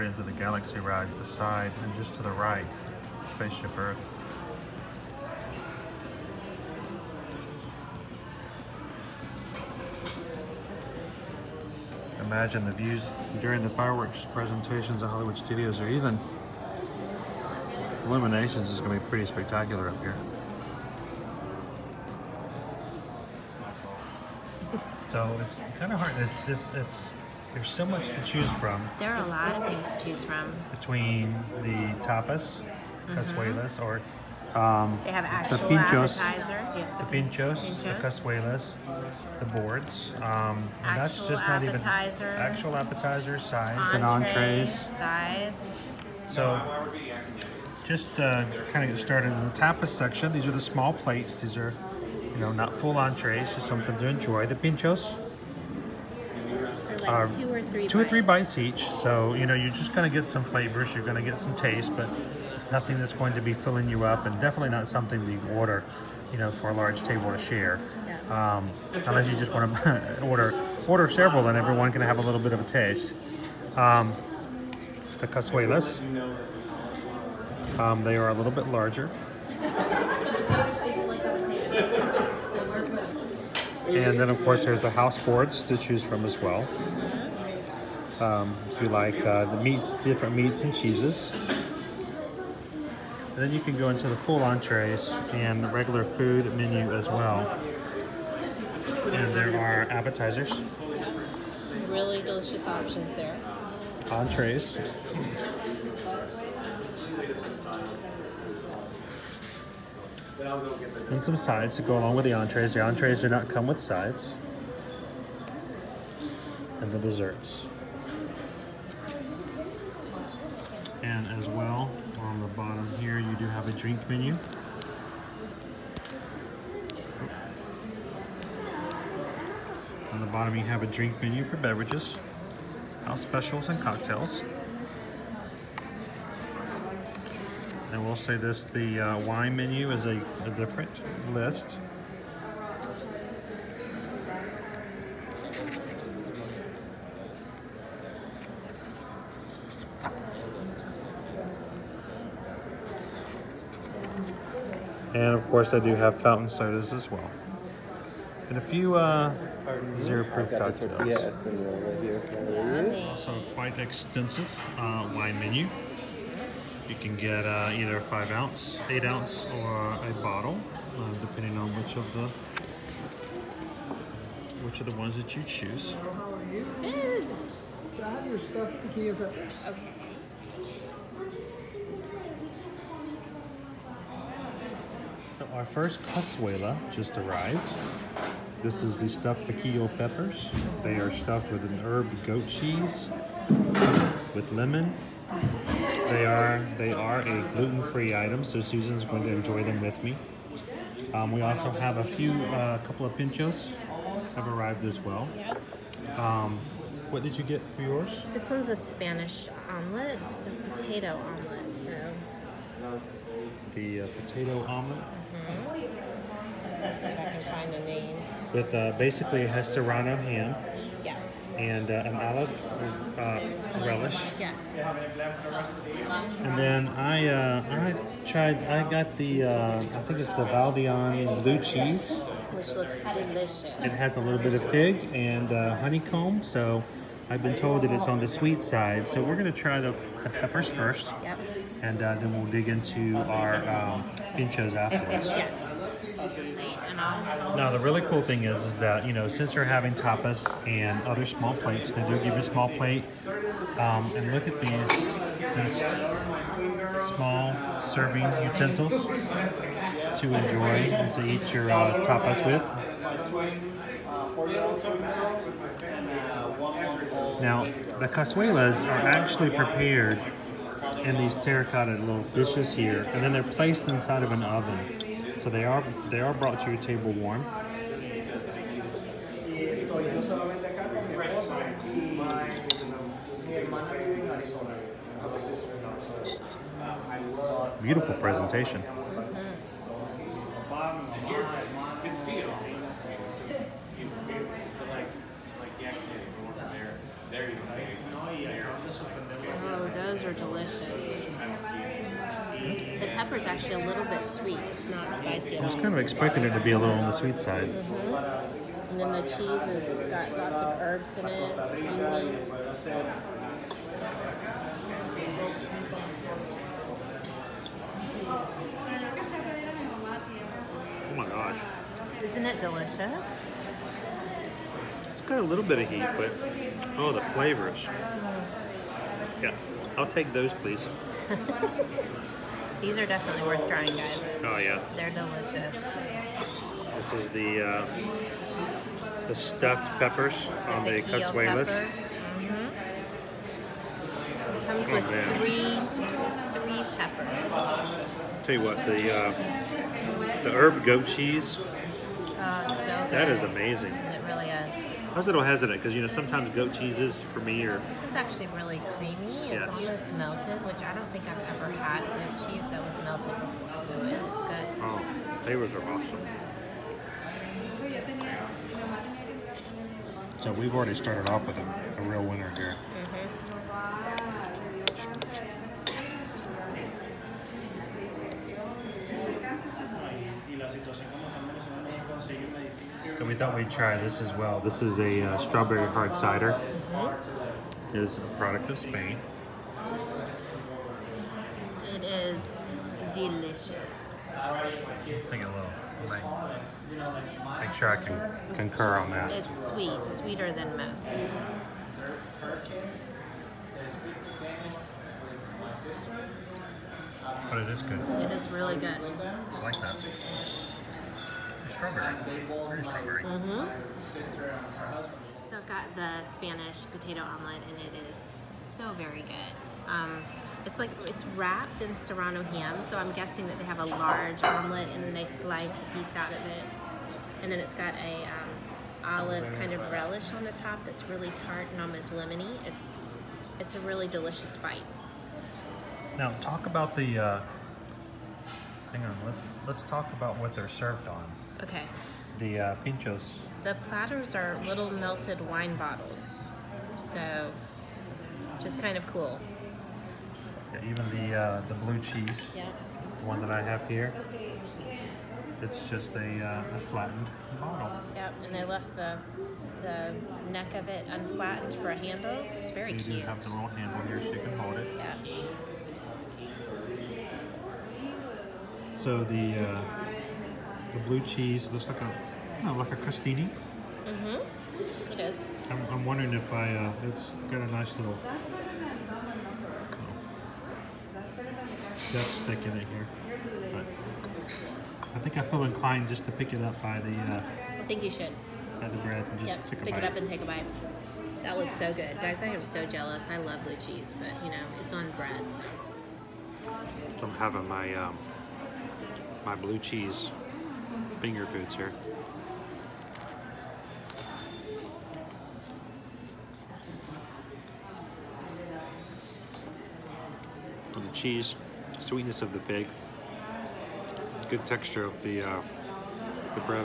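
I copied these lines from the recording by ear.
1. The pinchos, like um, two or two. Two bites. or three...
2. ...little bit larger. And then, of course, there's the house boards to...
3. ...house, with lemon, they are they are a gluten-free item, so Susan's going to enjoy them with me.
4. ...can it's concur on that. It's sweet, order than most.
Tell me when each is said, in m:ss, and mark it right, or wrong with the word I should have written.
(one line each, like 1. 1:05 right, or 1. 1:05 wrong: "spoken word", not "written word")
1. 0:54 wrong: "three", not "two"
2. 1:18 right
3. 3:12 wrong: "cheese", not "house"
4. 6:38 wrong: "sweeter", not "order".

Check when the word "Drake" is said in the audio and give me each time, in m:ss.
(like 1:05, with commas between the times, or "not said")
not said.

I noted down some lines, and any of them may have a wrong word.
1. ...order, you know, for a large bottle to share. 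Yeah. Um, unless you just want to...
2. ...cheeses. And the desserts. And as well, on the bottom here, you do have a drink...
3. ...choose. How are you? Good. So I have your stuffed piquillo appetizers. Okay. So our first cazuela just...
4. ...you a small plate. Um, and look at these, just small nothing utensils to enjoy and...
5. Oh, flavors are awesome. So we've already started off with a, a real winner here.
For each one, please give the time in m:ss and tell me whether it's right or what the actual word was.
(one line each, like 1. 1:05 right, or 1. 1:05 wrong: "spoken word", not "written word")
1. 1:05 wrong: "table", not "bottle"
2. 1:53 wrong: "sides", not "cheeses"
3. 2:55 wrong: "peppers", not "appetizers"
4. 4:12 wrong: "serving", not "nothing"
5. 6:04 right.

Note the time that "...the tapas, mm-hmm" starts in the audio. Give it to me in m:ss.
0:31.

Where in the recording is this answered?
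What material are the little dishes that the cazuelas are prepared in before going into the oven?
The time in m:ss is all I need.
4:31.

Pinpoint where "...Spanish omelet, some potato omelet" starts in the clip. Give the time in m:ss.
3:28.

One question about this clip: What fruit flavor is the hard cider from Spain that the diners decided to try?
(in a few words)
Strawberry.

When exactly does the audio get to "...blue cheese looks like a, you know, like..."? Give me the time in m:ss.
7:50.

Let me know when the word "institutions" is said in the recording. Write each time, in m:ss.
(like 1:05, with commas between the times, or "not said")
not said.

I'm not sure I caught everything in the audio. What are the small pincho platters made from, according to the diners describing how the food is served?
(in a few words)
Melted wine bottles.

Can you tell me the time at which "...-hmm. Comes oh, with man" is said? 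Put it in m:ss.
5:41.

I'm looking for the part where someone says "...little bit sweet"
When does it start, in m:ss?
5:03.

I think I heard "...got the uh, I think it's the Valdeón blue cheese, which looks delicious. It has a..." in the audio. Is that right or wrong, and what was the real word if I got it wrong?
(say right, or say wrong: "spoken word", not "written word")
right.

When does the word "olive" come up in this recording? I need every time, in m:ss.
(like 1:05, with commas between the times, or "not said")
3:42, 7:09.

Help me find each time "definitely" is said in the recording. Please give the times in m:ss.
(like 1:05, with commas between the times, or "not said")
1:04, 5:33.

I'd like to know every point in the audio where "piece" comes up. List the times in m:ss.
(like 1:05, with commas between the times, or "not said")
7:05.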